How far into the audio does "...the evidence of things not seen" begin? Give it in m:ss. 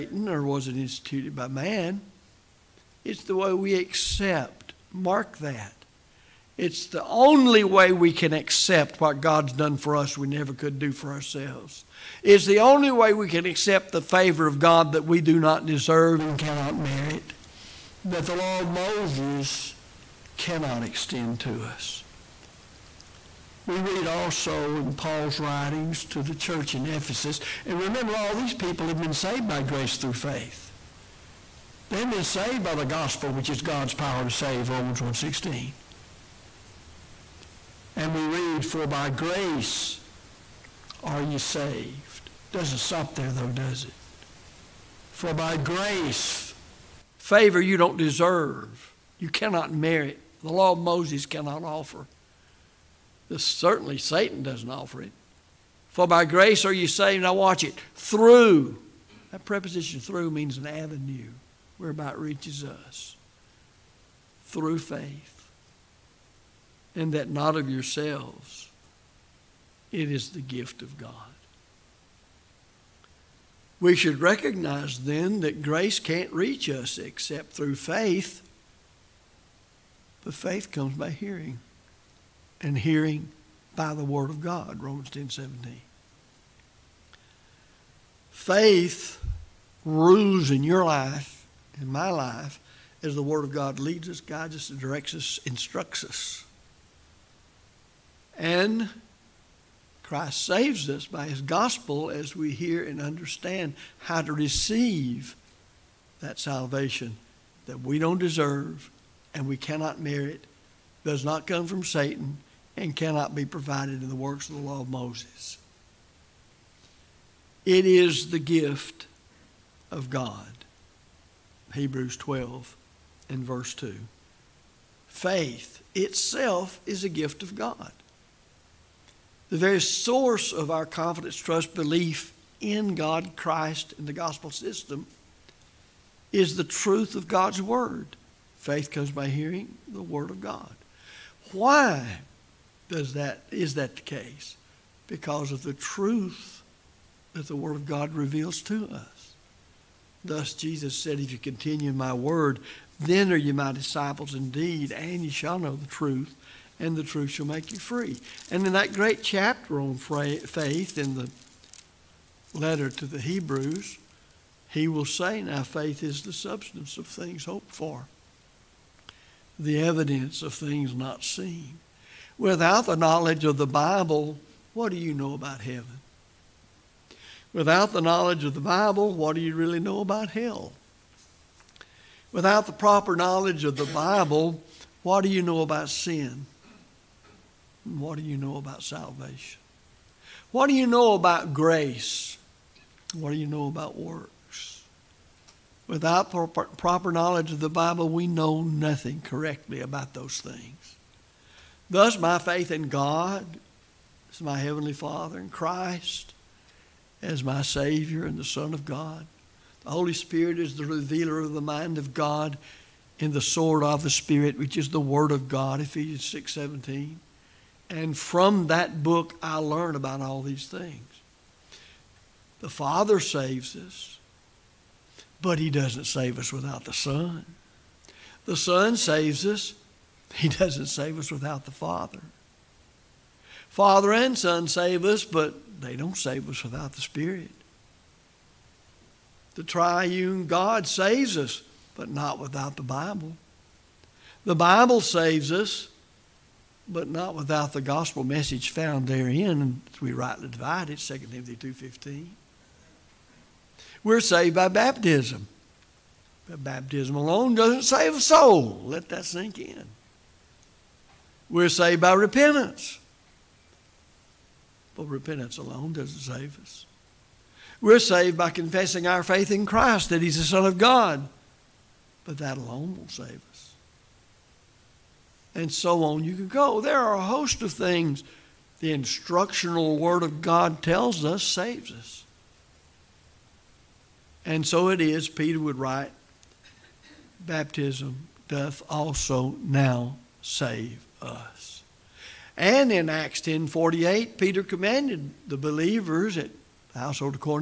2:49.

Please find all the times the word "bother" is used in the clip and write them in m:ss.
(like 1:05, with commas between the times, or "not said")
not said.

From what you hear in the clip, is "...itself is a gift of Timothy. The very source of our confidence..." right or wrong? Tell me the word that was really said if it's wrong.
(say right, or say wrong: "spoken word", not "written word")
wrong: "God", not "Timothy".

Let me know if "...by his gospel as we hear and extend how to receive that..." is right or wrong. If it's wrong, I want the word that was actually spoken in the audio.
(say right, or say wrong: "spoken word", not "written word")
wrong: "understand", not "extend".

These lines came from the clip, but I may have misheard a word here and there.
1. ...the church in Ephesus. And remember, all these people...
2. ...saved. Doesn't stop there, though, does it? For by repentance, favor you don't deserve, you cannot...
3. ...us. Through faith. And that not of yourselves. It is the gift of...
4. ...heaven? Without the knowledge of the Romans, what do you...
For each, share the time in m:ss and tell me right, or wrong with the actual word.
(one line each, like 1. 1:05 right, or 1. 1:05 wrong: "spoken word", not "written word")
1. 0:26 right
2. 0:41 wrong: "grace", not "repentance"
3. 1:02 right
4. 2:55 wrong: "Bible", not "Romans".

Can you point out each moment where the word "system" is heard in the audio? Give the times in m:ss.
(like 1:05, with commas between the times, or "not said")
2:14.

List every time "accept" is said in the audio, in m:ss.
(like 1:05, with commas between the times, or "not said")
0:03, 0:08, 0:13.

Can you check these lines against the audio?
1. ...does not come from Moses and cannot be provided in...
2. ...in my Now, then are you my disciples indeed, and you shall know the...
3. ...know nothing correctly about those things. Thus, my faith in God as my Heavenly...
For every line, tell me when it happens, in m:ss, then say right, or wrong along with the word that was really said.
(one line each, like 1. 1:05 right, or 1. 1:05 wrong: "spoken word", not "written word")
1. 1:51 wrong: "Satan", not "Moses"
2. 2:31 wrong: "Word", not "Now"
3. 3:18 right.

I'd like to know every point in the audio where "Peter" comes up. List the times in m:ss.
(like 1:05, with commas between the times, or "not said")
4:45, 4:54.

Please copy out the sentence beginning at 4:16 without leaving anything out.
But baptism alone doesn't save a soul.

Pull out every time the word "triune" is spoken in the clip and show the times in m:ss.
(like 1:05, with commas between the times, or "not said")
3:59.